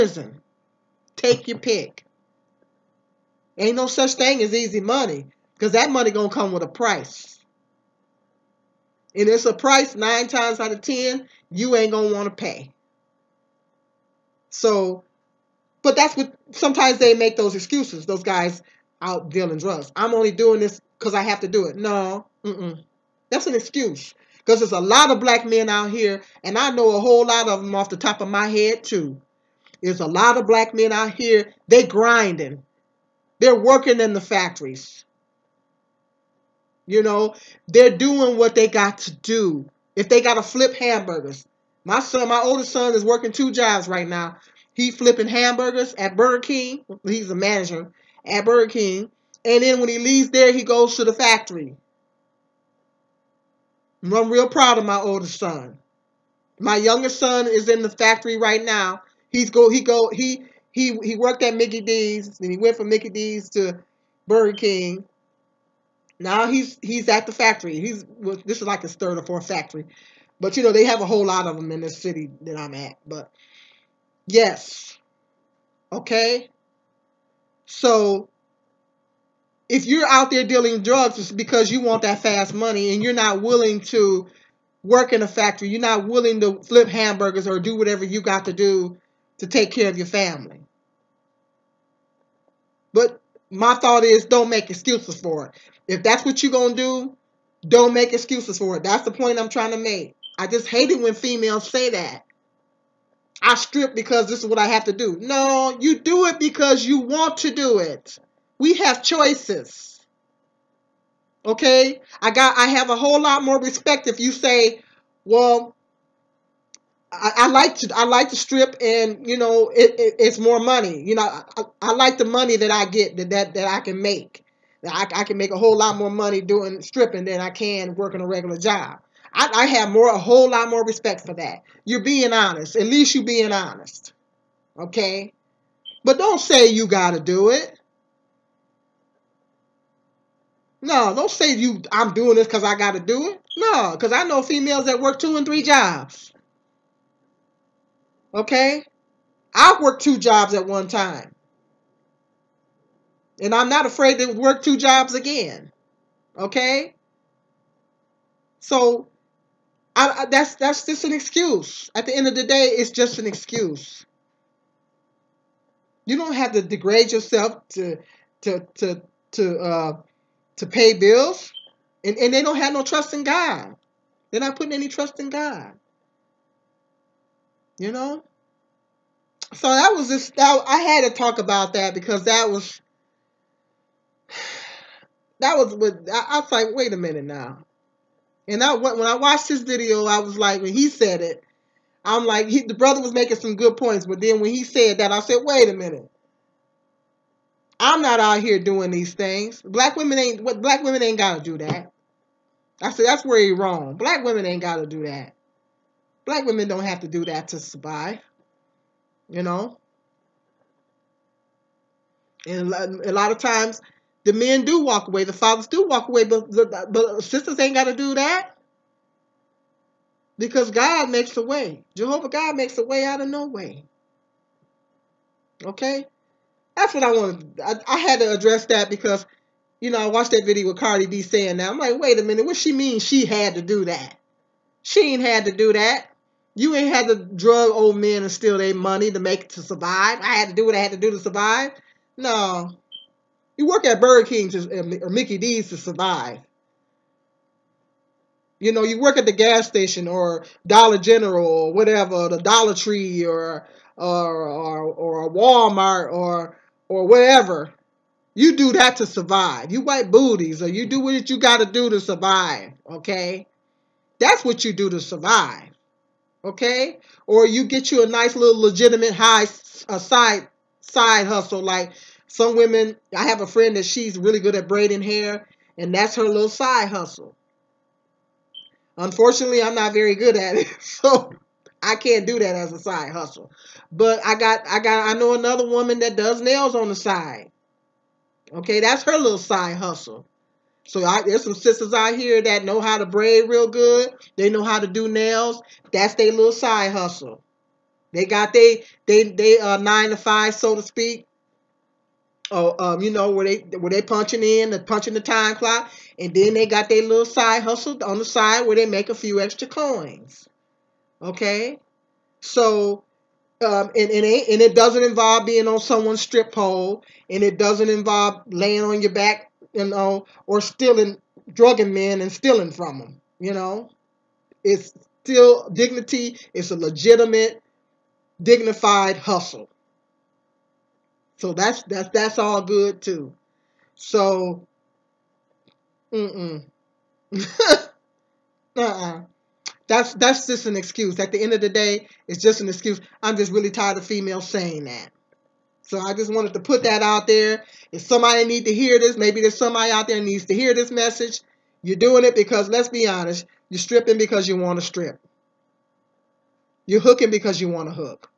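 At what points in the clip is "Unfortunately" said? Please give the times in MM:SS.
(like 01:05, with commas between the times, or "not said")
04:38.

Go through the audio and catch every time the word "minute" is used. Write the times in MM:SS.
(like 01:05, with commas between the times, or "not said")
03:06, 03:15, 03:52.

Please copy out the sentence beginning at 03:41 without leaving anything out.
Jehovah God makes a way out of no way.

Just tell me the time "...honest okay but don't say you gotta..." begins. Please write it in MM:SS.
02:13.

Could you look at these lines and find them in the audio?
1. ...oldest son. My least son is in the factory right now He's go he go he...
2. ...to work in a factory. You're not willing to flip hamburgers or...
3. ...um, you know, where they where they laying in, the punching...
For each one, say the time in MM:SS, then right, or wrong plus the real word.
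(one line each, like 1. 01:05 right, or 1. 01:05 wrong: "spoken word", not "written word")
1. 00:54 wrong: "youngest", not "least"
2. 01:23 right
3. 05:02 wrong: "punching", not "laying".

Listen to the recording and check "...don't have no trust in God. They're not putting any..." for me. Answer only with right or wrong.
right.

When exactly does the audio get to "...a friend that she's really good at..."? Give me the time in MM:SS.
04:33.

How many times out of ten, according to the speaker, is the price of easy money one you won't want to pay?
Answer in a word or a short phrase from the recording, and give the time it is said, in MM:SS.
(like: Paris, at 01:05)
9, at 00:09.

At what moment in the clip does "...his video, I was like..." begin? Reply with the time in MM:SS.
03:09.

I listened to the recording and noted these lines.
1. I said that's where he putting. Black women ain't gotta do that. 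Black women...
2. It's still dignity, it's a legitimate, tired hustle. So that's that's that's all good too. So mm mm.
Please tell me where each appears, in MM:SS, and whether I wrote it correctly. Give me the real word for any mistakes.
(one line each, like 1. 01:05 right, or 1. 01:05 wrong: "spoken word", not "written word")
1. 03:22 wrong: "wrong", not "putting"
2. 05:24 wrong: "dignified", not "tired".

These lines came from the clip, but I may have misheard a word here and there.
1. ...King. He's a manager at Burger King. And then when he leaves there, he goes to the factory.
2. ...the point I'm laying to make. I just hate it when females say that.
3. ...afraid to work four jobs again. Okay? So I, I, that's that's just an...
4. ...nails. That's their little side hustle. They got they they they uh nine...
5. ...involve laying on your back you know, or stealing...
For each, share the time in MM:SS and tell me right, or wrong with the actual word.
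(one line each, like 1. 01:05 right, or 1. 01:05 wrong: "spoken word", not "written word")
1. 00:46 right
2. 01:39 wrong: "trying", not "laying"
3. 02:33 wrong: "two", not "four"
4. 04:55 right
5. 05:17 right.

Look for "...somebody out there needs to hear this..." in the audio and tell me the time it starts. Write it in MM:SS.
05:49.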